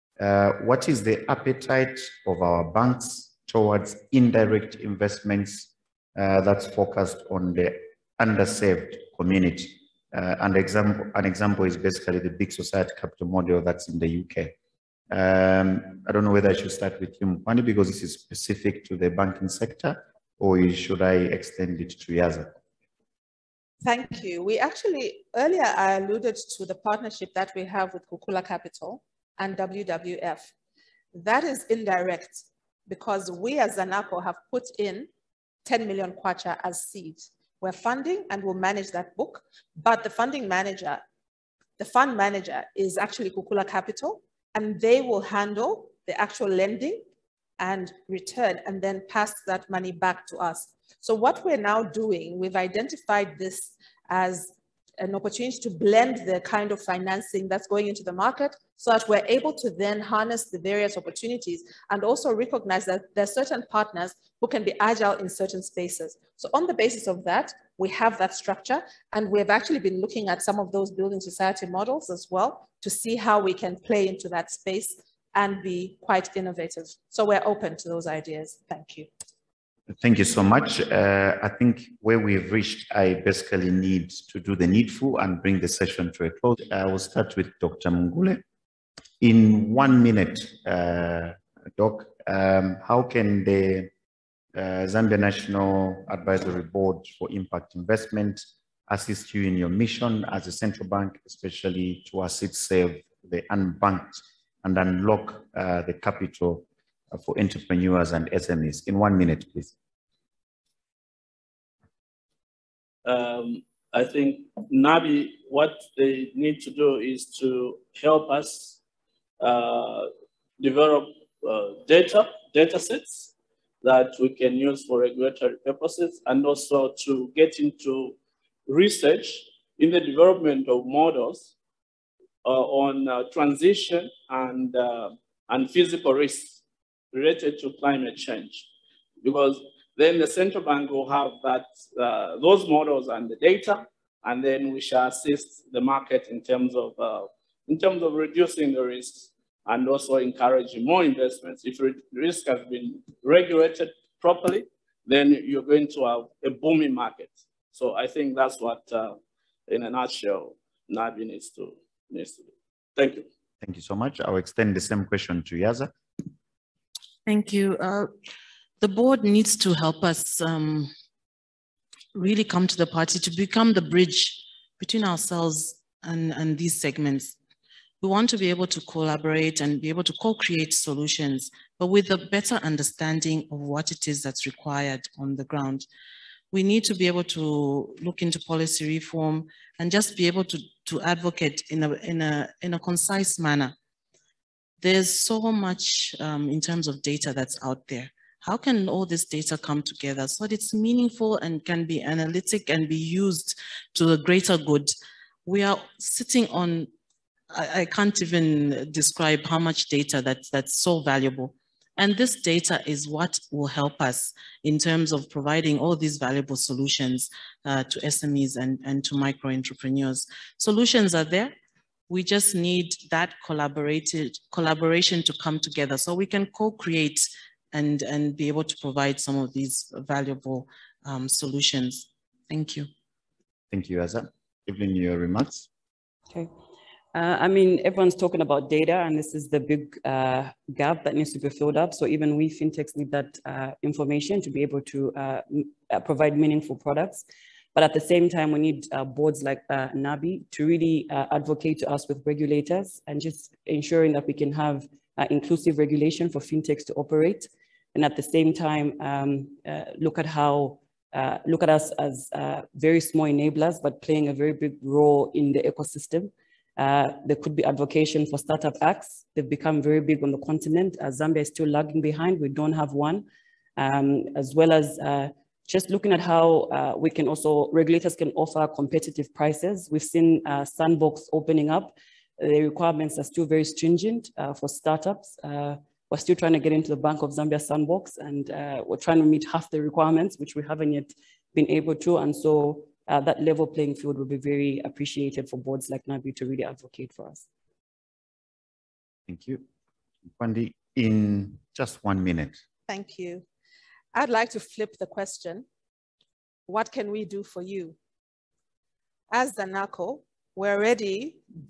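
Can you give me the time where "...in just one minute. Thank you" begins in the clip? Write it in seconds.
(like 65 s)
300 s.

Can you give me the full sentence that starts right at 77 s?
So we're open to those ideas.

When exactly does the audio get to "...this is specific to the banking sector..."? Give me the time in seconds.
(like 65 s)
17 s.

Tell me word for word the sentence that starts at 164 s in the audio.
I'll extend the same question to Yaza.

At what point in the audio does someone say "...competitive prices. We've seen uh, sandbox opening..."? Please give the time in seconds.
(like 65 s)
278 s.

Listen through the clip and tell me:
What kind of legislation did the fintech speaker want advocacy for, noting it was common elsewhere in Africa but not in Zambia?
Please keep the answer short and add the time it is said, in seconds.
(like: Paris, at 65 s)
Startup acts, at 268 s.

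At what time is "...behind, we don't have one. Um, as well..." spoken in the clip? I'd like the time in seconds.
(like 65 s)
272 s.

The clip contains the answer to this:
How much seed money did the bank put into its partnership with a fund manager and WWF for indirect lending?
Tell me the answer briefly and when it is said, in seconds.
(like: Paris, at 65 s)
10 million kwacha, at 35 s.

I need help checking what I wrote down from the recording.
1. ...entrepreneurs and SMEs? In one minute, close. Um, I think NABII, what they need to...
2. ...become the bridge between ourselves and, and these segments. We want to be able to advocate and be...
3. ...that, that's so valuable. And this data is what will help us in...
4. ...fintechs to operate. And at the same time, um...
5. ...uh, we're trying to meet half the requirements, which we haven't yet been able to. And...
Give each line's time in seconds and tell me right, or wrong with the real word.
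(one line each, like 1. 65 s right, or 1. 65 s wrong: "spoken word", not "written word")
1. 107 s wrong: "please", not "close"
2. 173 s wrong: "collaborate", not "advocate"
3. 210 s right
4. 256 s right
5. 288 s right.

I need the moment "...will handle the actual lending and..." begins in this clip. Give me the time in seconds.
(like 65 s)
44 s.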